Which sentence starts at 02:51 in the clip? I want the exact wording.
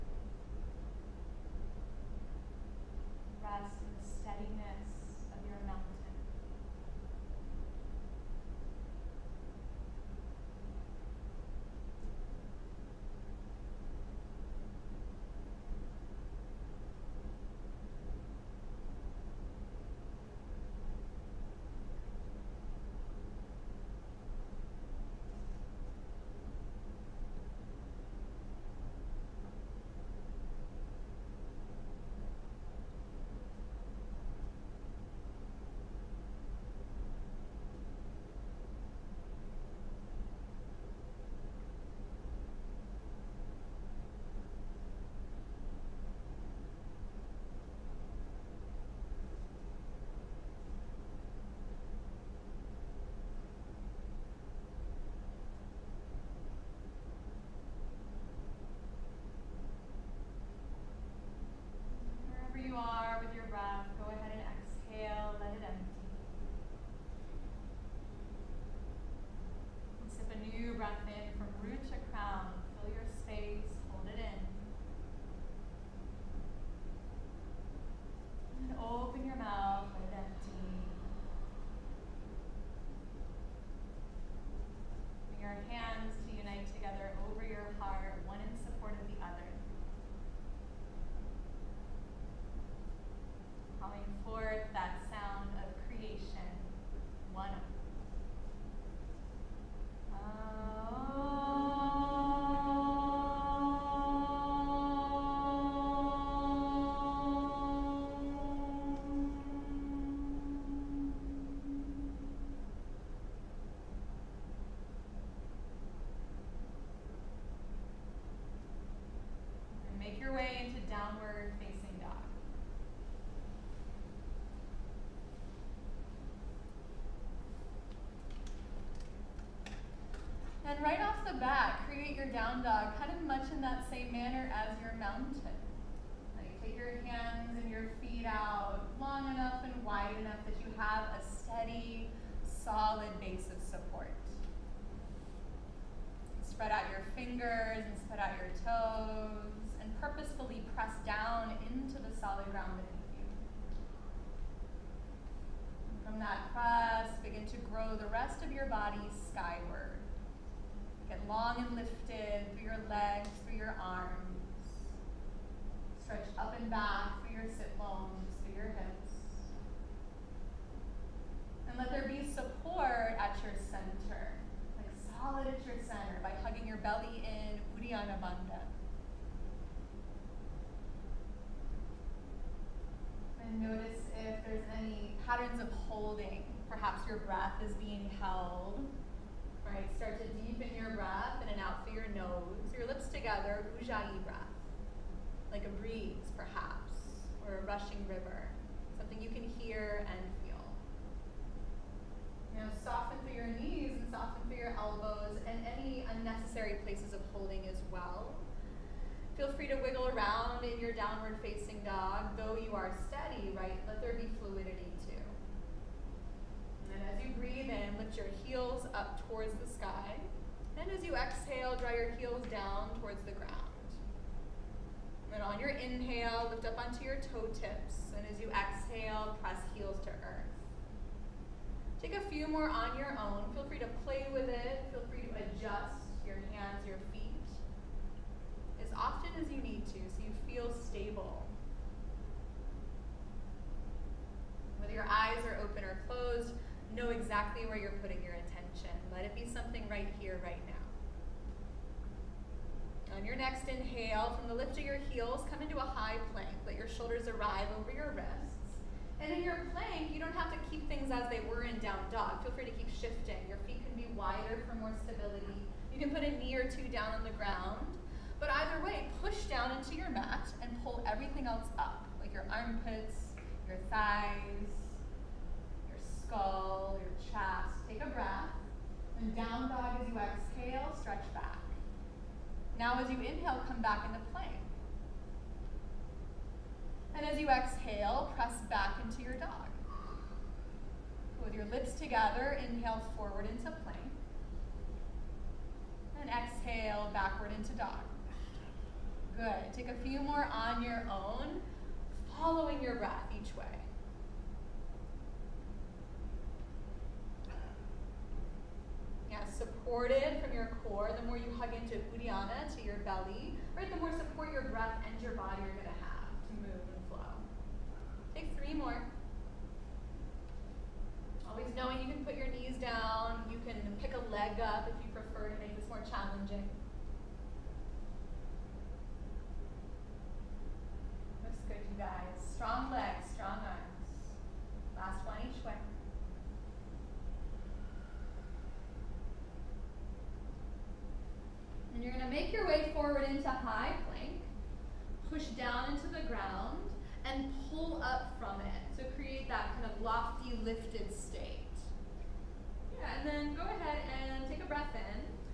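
And let there be support at your center, like solid at your center by hugging your belly in Uddiyana Bandha.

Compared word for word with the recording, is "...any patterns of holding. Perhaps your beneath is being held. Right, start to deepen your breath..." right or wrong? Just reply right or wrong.
wrong.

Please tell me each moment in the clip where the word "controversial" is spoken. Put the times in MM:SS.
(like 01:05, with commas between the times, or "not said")
not said.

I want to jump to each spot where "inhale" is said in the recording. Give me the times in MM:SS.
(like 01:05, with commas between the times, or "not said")
03:45, 04:13, 04:43, 04:52.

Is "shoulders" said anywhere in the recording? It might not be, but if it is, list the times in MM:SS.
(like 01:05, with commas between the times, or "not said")
04:16.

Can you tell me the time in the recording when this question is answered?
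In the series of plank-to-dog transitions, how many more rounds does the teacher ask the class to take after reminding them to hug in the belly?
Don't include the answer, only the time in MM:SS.
05:18.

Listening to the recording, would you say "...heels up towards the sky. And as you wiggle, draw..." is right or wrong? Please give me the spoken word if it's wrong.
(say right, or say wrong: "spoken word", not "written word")
wrong: "exhale", not "wiggle".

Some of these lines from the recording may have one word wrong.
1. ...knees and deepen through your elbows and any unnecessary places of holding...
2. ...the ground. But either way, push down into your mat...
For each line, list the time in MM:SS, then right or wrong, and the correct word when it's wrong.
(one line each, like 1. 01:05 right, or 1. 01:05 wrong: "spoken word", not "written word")
1. 03:23 wrong: "soften", not "deepen"
2. 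04:27 right.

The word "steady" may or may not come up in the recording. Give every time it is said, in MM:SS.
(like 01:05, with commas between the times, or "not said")
02:21, 03:33.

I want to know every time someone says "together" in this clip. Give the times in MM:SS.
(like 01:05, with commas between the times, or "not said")
03:13, 04:51.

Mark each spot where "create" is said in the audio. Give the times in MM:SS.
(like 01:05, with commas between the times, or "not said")
02:11, 05:49.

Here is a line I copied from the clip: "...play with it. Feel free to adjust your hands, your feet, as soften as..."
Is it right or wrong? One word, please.
wrong.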